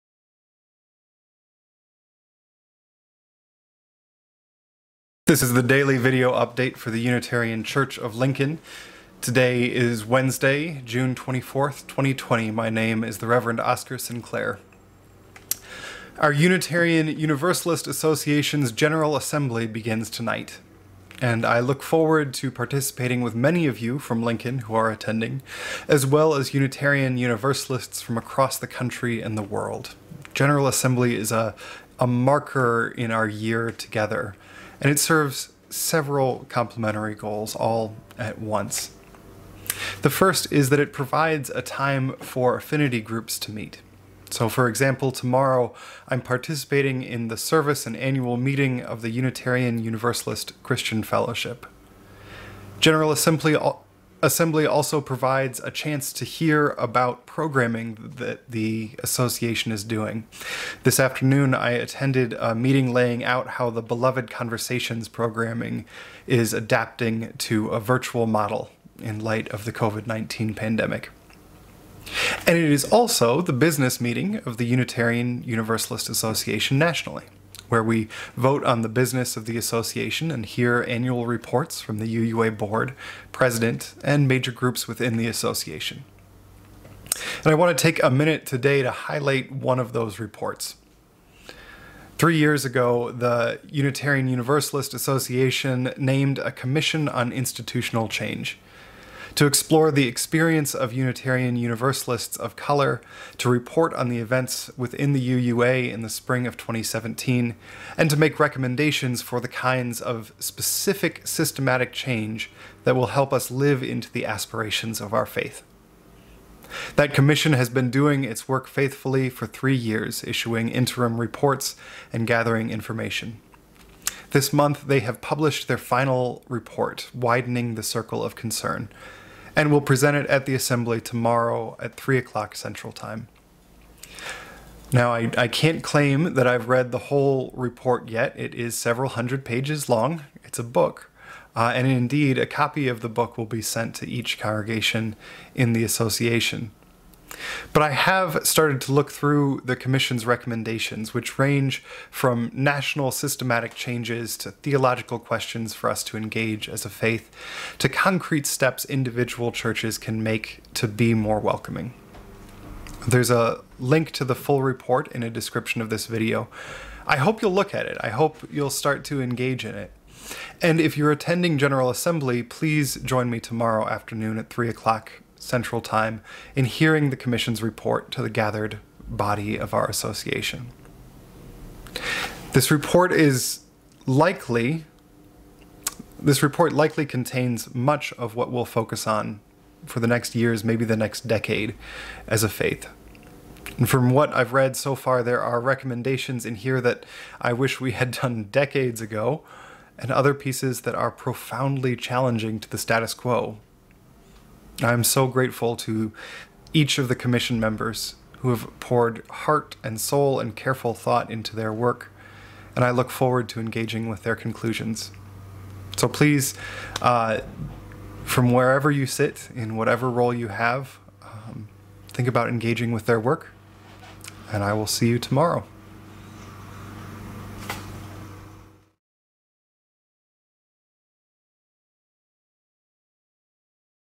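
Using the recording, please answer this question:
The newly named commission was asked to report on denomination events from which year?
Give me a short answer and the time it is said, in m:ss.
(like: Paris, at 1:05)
2017, at 1:46.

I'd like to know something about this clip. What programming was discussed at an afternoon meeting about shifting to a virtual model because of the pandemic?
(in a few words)
Beloved Conversations.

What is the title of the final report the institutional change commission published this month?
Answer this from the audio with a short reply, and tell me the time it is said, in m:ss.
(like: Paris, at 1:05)
Widening the Circle of Concern, at 2:07.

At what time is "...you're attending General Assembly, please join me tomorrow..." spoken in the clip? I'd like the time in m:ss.
2:50.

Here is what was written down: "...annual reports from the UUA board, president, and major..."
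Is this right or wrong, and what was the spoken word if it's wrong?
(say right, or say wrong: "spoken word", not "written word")
right.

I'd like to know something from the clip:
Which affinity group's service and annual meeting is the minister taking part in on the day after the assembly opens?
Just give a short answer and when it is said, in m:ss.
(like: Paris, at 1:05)
Unitarian Universalist Christian Fellowship, at 0:49.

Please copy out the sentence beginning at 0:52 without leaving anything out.
General Assembly Assembly also provides a chance to hear about programming that the association is doing.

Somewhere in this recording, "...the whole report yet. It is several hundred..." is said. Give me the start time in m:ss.
2:16.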